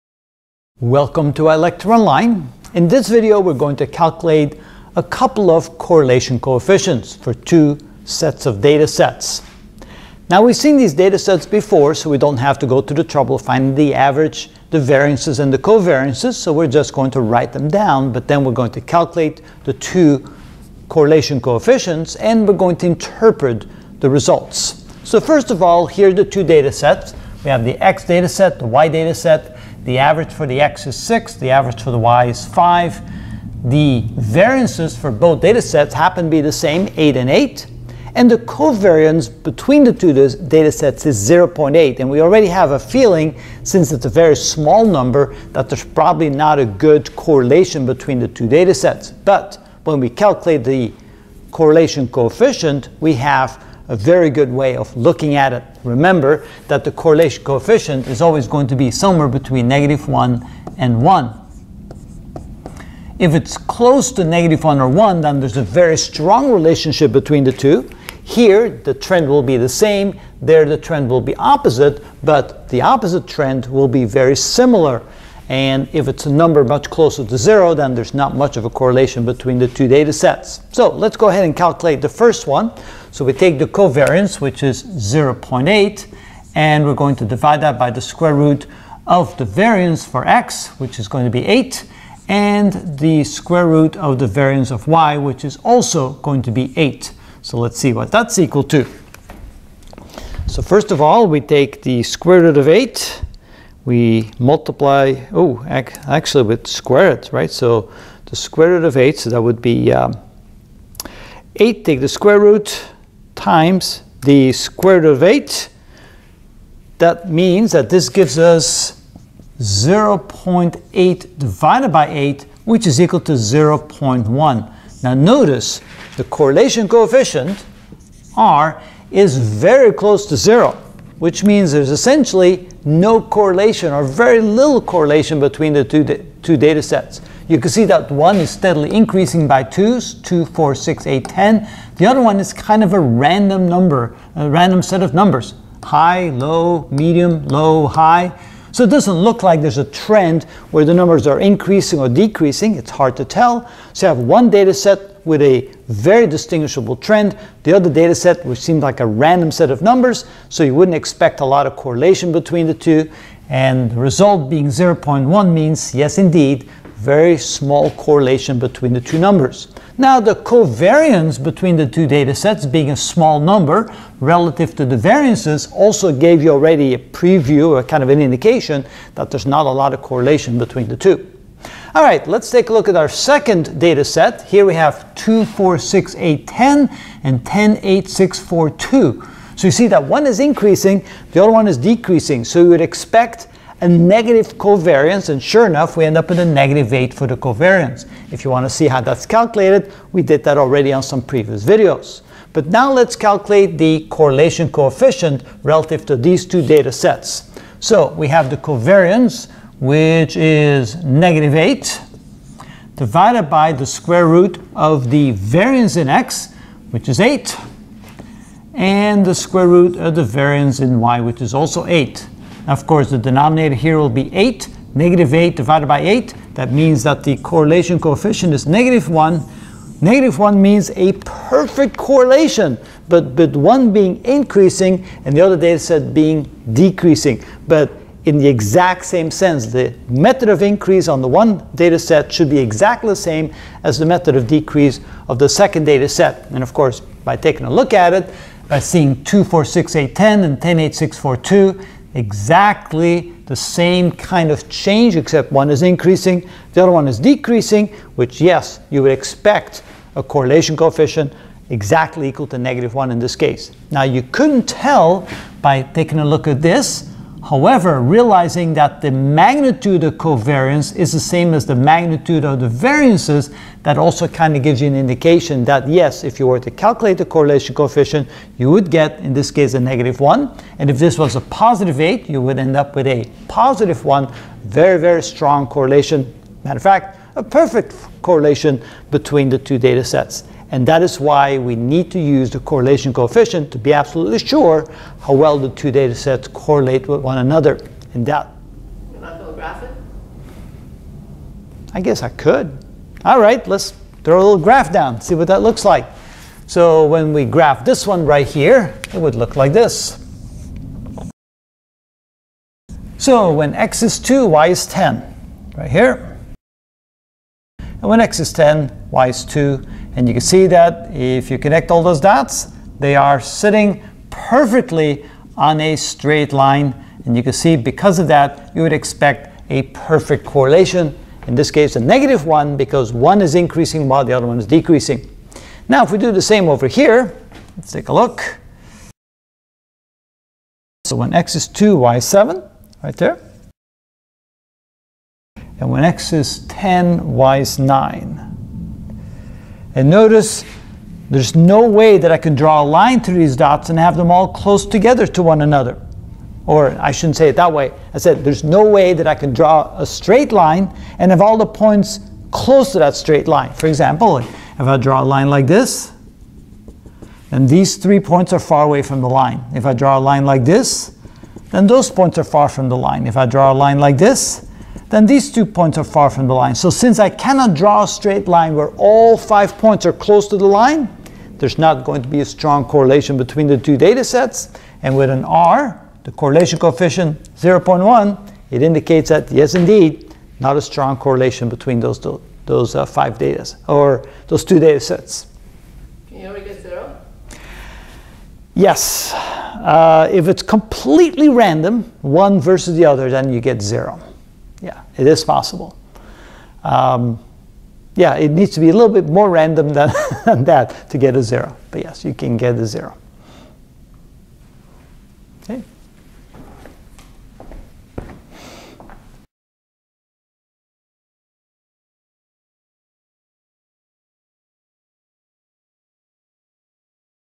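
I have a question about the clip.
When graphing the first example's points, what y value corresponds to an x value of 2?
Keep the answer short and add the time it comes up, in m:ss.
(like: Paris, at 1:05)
7, at 5:41.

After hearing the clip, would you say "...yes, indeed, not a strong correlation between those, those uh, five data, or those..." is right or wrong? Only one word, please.
right.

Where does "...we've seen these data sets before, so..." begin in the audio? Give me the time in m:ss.
0:10.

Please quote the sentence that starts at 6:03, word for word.
For example, if I draw a line like this, then these three points are far away from the line.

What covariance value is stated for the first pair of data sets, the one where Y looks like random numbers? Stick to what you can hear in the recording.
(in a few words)
0.8.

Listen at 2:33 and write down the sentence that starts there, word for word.
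So you have one data set with a very distinguishable trend.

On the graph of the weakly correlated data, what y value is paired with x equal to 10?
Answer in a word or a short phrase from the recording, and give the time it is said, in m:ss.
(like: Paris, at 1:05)
9, at 5:45.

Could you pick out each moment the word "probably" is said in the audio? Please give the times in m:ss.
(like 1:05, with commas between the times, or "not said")
0:45.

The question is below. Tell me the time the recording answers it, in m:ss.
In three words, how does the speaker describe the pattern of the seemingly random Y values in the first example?
2:25.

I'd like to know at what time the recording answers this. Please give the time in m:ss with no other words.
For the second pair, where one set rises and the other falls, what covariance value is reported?
3:15.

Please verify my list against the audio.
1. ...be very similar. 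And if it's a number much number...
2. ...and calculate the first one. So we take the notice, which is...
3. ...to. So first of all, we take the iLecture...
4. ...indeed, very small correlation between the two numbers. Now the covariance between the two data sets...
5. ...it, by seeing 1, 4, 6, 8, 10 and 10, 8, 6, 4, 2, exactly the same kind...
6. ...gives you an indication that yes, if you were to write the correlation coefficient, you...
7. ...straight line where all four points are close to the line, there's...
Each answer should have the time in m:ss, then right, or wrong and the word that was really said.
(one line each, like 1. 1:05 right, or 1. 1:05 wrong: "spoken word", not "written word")
1. 1:13 wrong: "closer", not "number"
2. 1:21 wrong: "covariance", not "notice"
3. 1:38 wrong: "square", not "iLecture"
4. 2:46 right
5. 4:08 wrong: "2", not "1"
6. 4:34 wrong: "calculate", not "write"
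7. 6:18 wrong: "five", not "four".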